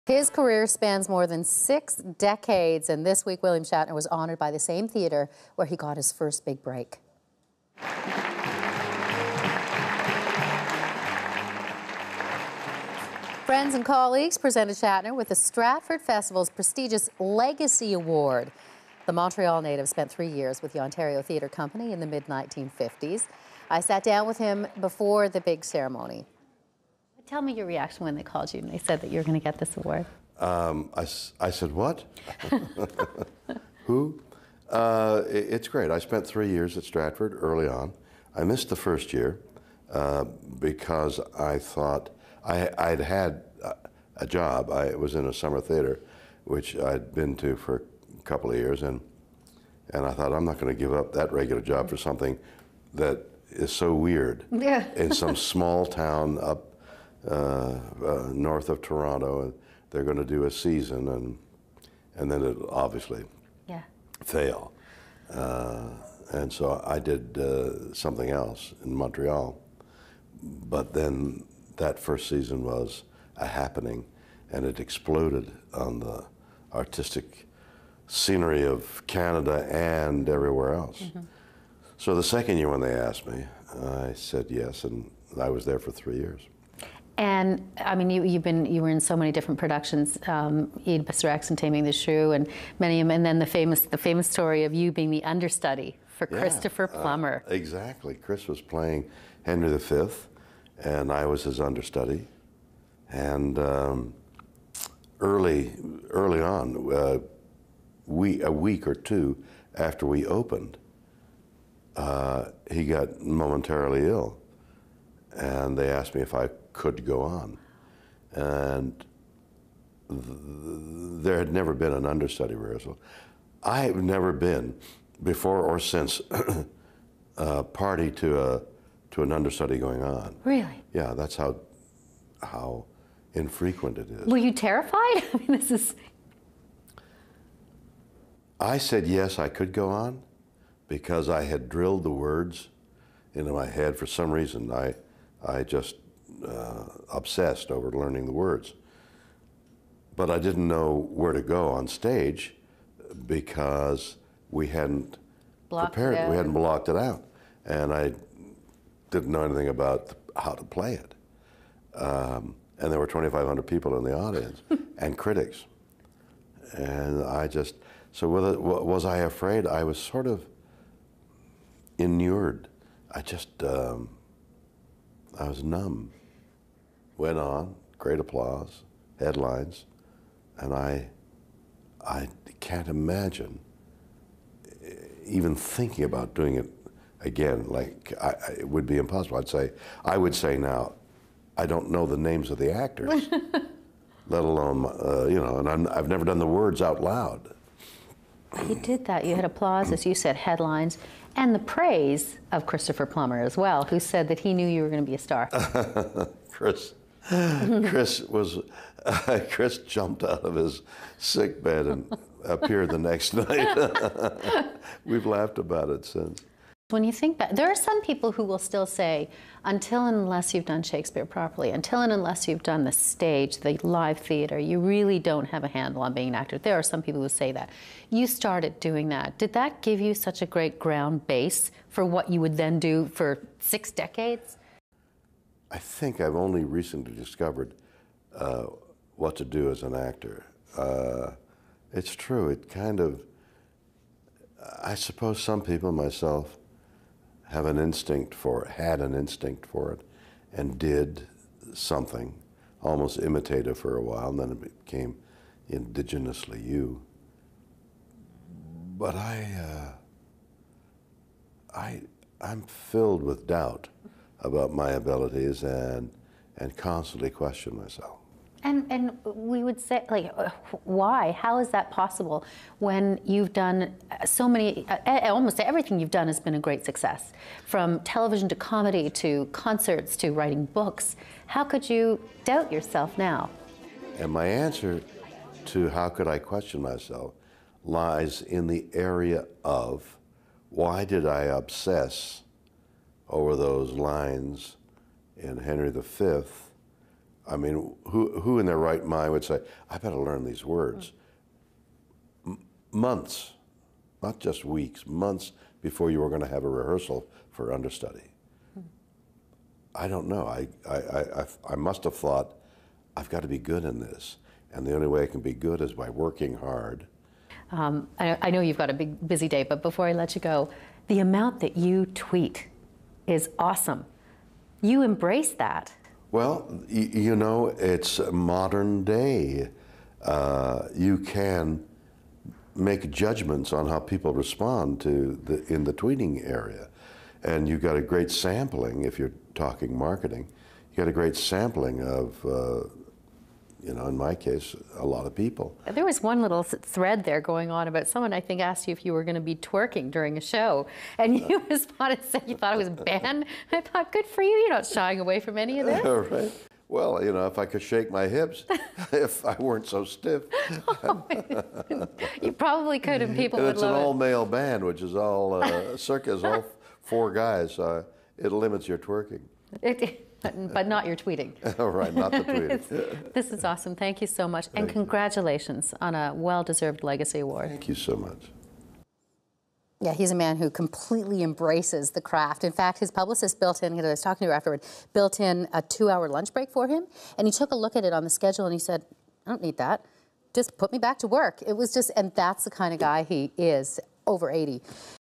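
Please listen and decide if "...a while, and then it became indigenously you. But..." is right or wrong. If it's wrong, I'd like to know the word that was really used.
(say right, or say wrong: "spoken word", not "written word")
right.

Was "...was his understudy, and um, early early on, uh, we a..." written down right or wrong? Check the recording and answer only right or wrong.
right.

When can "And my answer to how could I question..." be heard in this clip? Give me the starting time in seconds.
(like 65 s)
284 s.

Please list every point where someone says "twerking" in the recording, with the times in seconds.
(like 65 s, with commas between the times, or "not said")
349 s, 368 s.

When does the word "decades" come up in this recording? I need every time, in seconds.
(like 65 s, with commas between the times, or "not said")
1 s, 233 s.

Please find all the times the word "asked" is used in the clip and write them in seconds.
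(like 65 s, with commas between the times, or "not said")
82 s, 115 s, 348 s.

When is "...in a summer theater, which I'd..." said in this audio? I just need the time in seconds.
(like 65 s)
45 s.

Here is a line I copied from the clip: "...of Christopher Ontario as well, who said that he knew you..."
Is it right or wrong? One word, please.
wrong.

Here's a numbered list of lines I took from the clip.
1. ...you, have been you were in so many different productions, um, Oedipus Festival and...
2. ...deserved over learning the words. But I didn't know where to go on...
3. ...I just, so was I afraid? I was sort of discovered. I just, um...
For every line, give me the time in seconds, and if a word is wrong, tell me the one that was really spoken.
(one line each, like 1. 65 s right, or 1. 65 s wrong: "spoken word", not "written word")
1. 88 s wrong: "Rex", not "Festival"
2. 147 s wrong: "obsessed", not "deserved"
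3. 167 s wrong: "inured", not "discovered".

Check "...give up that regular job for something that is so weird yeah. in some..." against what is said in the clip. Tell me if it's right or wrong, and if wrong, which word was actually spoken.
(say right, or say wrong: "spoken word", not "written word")
right.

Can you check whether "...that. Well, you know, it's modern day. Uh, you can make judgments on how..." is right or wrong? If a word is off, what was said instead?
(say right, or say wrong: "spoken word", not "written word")
right.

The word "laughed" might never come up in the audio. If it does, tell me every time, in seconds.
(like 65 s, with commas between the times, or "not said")
215 s.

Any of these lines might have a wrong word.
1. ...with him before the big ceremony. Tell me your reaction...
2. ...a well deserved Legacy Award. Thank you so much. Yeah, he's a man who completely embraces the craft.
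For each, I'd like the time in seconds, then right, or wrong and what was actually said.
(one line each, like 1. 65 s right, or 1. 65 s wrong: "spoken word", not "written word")
1. 24 s right
2. 376 s right.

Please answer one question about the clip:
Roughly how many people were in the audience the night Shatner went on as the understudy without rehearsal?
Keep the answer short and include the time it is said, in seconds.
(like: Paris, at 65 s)
2,500, at 163 s.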